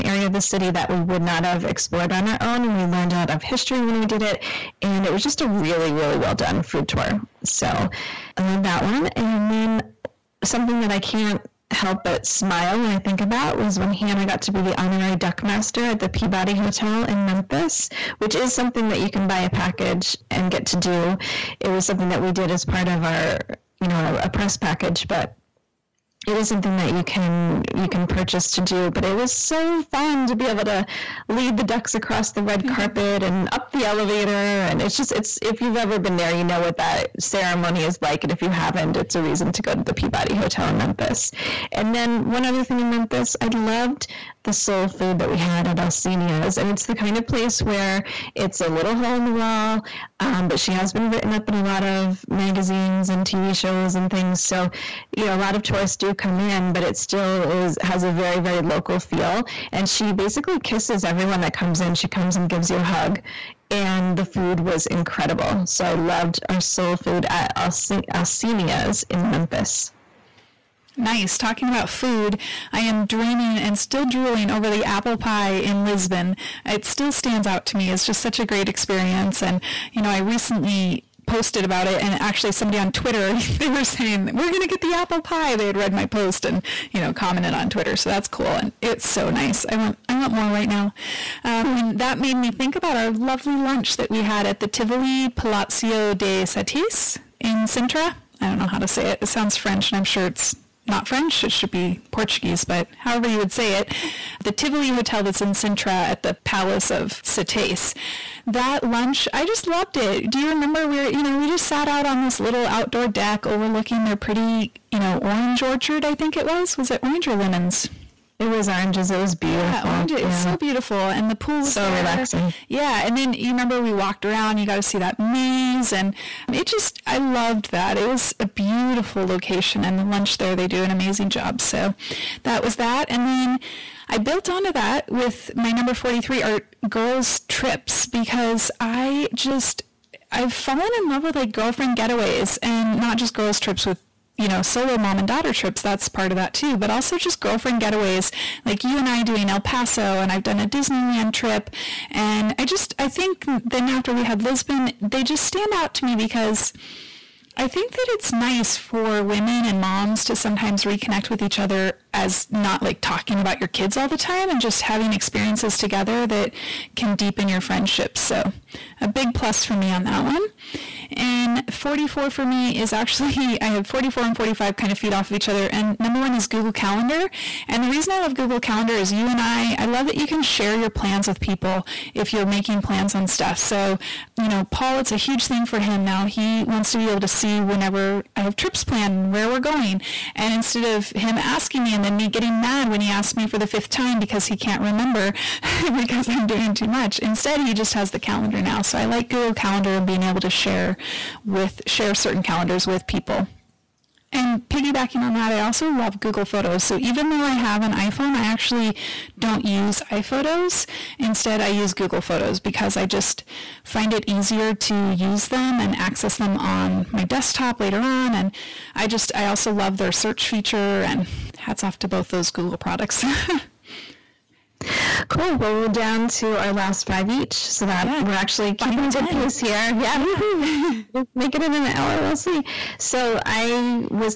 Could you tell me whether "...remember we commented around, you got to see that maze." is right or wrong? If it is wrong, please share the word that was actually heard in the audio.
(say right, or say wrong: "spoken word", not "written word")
wrong: "walked", not "commented".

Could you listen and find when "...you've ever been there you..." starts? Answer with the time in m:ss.
0:35.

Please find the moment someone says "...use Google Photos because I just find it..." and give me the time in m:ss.
3:31.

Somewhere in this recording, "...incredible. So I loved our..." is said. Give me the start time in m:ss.
1:04.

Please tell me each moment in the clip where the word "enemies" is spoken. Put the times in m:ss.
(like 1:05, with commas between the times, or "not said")
not said.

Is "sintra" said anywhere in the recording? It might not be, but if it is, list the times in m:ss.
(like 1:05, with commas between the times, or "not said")
1:37, 1:45.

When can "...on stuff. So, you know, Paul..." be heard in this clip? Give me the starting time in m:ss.
3:03.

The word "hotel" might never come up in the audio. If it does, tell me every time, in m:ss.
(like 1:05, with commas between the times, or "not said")
0:16, 0:40, 1:44.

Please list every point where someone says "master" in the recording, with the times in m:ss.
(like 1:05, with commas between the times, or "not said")
0:15.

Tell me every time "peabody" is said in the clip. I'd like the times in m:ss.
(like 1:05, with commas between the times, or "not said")
0:16, 0:39.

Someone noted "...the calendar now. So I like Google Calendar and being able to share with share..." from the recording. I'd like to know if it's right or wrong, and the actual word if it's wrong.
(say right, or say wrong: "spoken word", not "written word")
right.